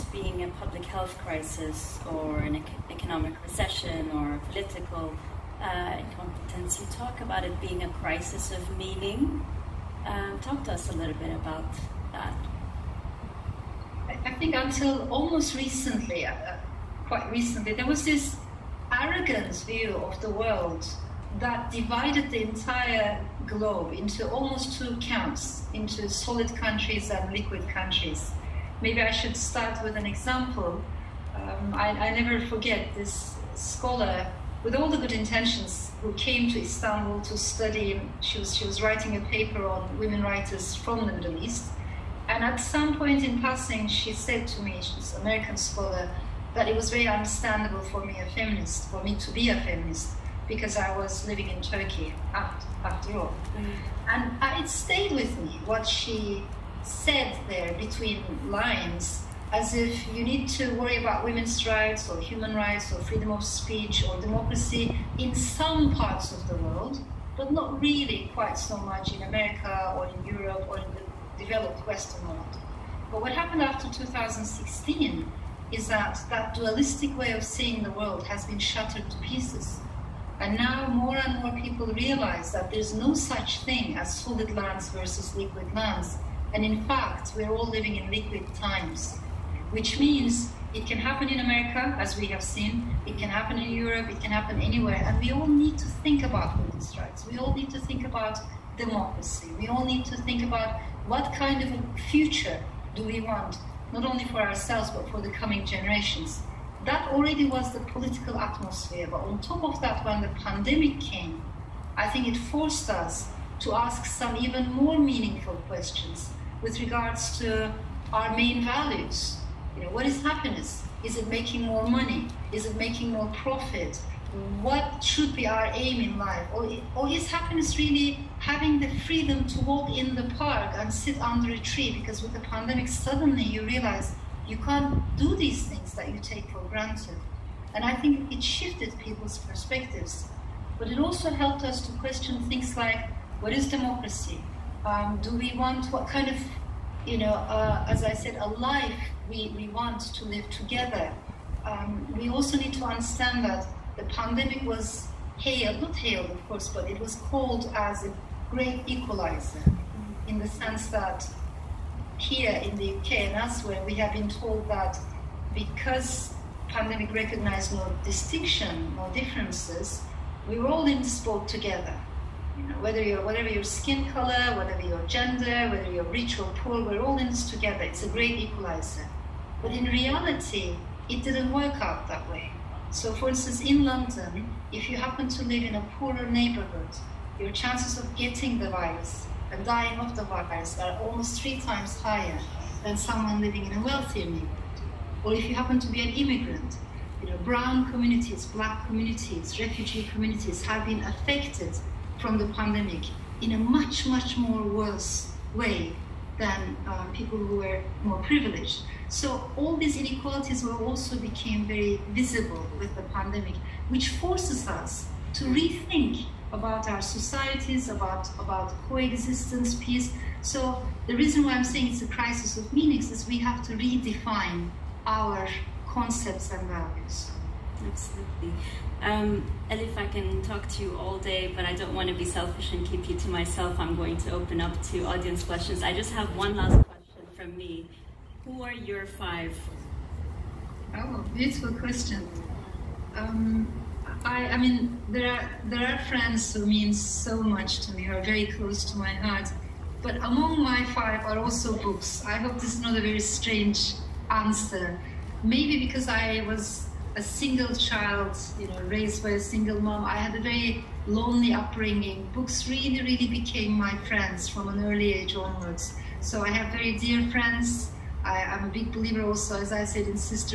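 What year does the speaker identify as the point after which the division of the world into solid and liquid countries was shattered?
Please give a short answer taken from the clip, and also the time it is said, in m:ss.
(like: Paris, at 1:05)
2016, at 1:13.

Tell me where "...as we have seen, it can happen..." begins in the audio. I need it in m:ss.
1:31.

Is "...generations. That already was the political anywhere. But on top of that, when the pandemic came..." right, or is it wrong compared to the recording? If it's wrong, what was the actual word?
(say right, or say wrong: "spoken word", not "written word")
wrong: "atmosphere", not "anywhere".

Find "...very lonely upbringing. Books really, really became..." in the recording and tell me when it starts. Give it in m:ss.
4:20.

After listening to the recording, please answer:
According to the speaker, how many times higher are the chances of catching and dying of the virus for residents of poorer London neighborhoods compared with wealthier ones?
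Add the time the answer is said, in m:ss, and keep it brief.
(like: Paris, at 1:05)
3, at 3:11.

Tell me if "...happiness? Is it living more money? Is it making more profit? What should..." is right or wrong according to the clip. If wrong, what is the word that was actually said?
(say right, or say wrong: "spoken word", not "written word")
wrong: "making", not "living".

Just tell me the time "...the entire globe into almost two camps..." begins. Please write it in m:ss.
0:22.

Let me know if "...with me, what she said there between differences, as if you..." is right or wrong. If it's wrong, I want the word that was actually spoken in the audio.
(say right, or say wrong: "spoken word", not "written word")
wrong: "lines", not "differences".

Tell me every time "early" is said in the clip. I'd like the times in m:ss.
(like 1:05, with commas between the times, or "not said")
4:24.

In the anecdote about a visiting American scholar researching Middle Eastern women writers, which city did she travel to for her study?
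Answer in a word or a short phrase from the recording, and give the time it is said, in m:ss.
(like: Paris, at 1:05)
Istanbul, at 0:36.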